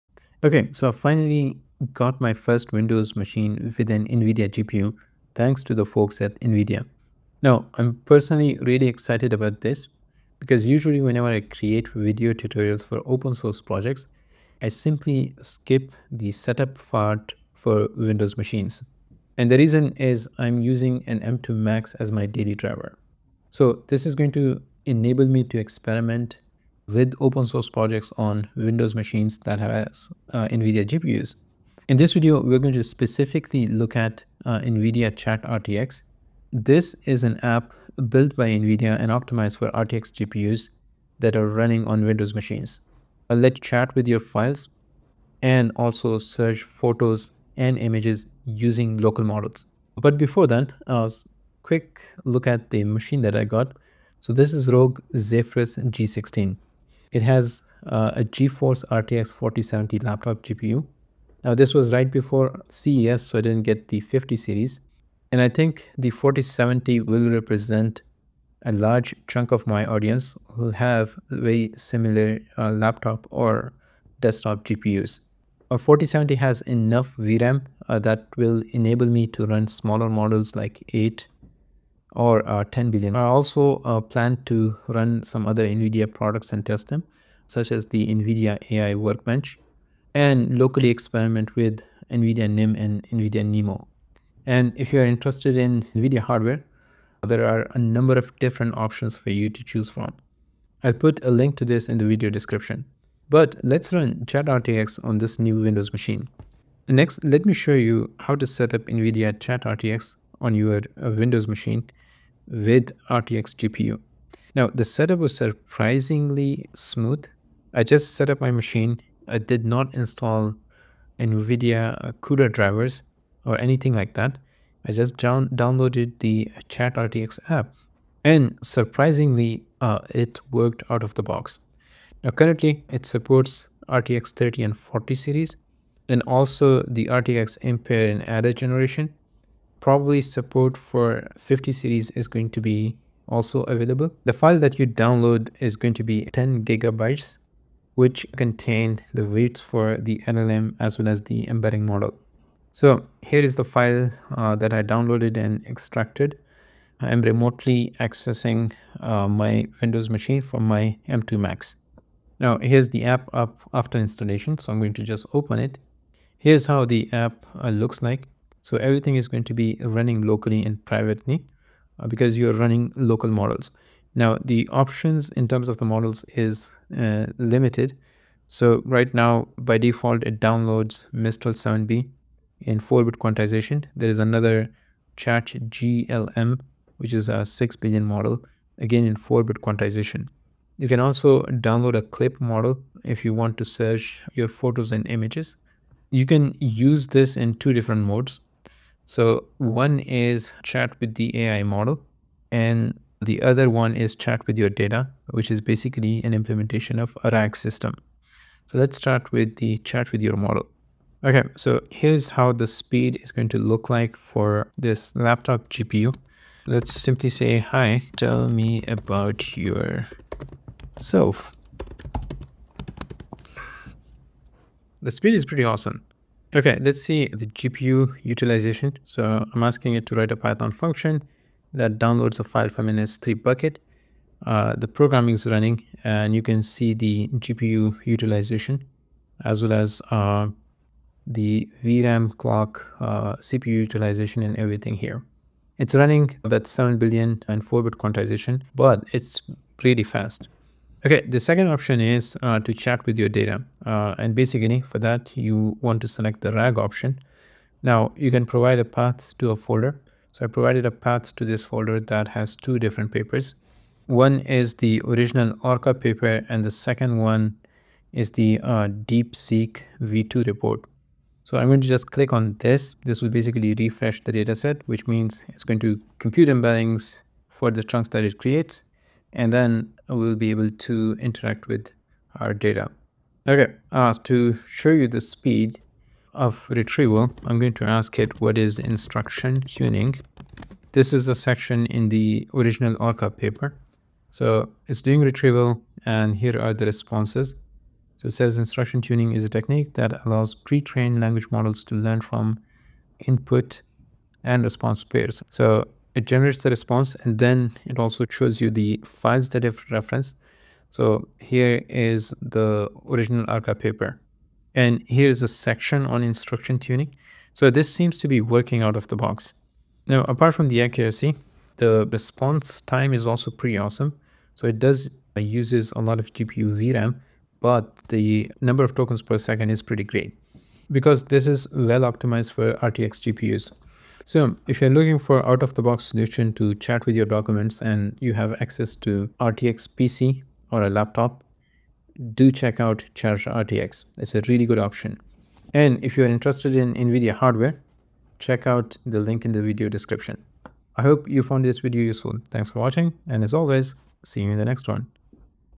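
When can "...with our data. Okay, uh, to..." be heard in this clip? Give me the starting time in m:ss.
4:41.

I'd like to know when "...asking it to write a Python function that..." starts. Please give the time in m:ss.
3:49.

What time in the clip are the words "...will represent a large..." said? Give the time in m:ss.
1:07.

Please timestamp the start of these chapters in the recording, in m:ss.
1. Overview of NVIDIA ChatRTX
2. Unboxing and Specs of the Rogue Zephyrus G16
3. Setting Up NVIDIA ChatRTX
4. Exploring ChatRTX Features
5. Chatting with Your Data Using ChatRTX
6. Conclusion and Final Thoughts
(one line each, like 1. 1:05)
1. 0:31
2. 0:54
3. 1:46
4. 2:46
5. 4:10
6. 5:34.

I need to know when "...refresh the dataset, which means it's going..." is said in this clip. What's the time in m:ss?
4:33.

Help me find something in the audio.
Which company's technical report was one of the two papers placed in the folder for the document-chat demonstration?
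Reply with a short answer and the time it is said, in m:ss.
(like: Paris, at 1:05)
DeepSeek v2, at 4:28.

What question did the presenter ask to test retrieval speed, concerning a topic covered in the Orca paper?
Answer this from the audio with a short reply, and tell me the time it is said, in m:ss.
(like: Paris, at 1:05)
What is instruction tuning, at 4:48.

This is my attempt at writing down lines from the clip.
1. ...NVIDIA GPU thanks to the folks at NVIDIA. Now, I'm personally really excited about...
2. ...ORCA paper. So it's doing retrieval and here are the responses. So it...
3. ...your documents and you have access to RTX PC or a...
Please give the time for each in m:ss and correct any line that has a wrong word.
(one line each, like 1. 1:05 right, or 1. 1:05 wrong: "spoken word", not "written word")
1. 0:04 right
2. 4:52 right
3. 5:37 right.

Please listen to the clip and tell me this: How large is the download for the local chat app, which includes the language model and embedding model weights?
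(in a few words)
10 gigabytes.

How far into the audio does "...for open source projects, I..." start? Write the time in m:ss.
0:12.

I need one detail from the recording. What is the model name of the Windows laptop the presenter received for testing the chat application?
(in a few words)
Rogue Zephyrus G16.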